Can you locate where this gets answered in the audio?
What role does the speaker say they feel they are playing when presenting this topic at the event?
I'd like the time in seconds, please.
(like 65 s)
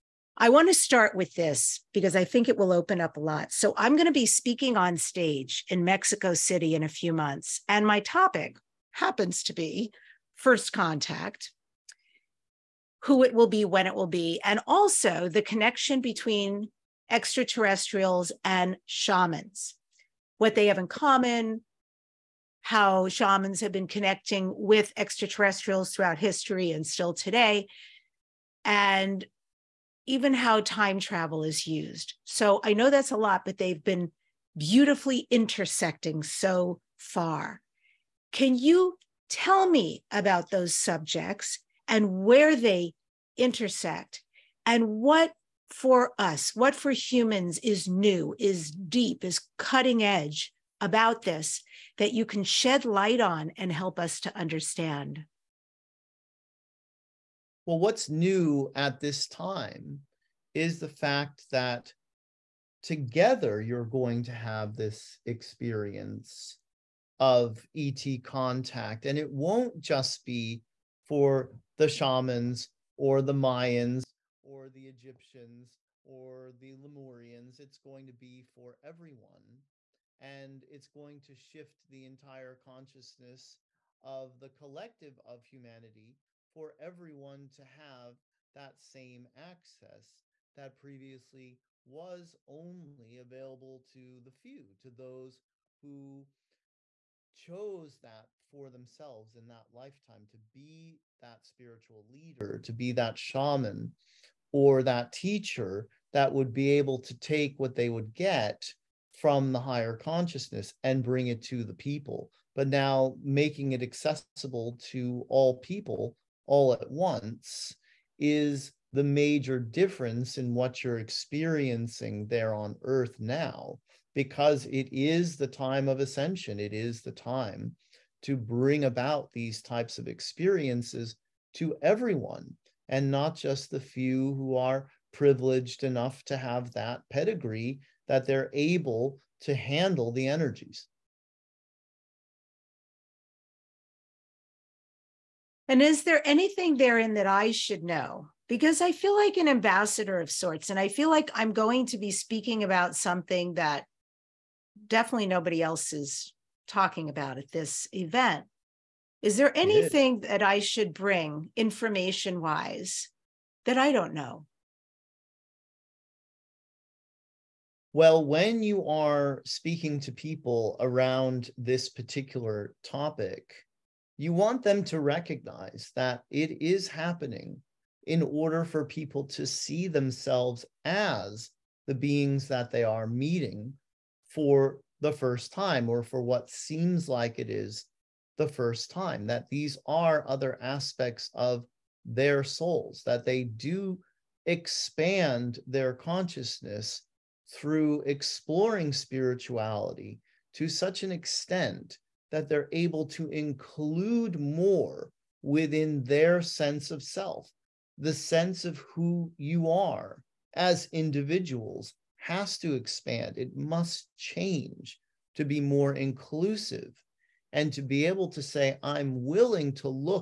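149 s.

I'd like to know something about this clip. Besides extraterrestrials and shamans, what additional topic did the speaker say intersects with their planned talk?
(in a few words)
Time travel.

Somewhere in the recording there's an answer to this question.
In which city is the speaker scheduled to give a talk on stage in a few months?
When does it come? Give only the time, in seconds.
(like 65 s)
5 s.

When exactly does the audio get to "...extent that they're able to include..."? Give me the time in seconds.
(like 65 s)
201 s.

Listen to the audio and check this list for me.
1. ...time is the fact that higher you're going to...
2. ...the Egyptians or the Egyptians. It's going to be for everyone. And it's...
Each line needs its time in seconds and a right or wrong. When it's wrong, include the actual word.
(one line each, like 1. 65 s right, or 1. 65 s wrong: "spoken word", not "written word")
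1. 59 s wrong: "together", not "higher"
2. 74 s wrong: "Lemurians", not "Egyptians".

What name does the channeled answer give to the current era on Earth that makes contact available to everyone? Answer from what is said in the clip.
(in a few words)
Ascension.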